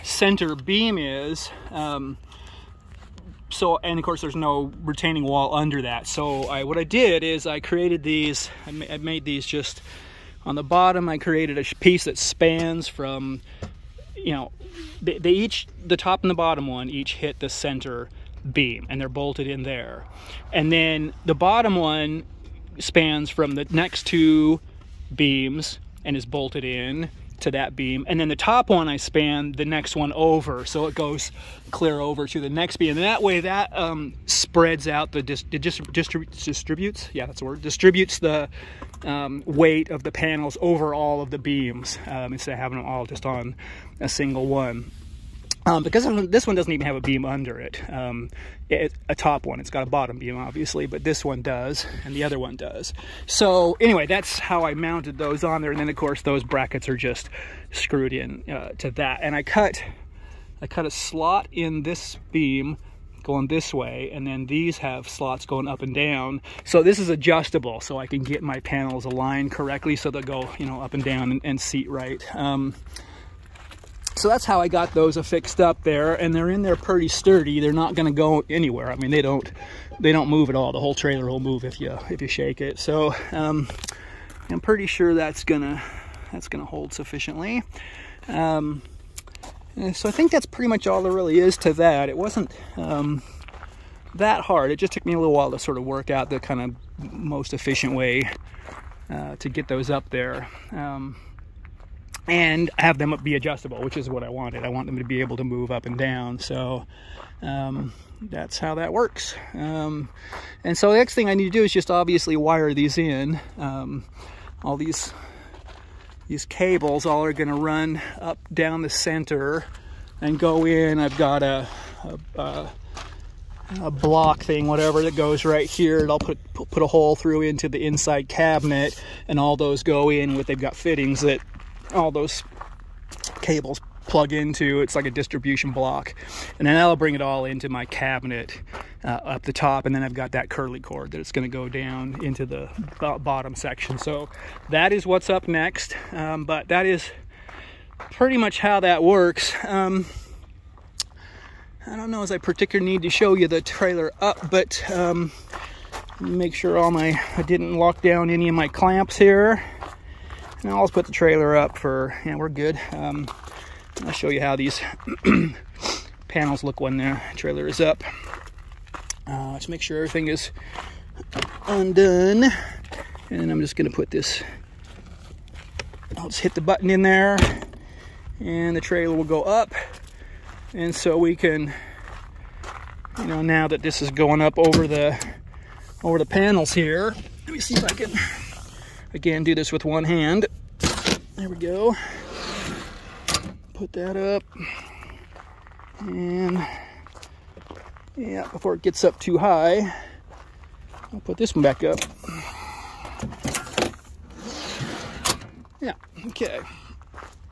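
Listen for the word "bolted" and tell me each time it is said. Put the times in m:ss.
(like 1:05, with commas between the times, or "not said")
0:19, 0:26.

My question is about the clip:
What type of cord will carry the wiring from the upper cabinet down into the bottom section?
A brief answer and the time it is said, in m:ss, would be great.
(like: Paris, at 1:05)
Curly cord, at 2:20.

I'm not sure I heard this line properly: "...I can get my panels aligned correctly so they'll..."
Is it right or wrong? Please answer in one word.
right.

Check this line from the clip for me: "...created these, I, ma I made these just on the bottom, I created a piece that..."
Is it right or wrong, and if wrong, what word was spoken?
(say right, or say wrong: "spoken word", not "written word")
right.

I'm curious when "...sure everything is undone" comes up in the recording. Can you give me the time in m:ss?
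2:49.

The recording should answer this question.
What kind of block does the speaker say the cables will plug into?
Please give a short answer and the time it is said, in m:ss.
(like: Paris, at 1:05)
Distribution block, at 2:15.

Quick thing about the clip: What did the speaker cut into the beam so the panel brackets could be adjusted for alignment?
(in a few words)
A slot.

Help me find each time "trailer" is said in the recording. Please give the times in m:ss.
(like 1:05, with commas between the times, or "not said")
1:20, 2:33, 2:41, 2:47, 2:58.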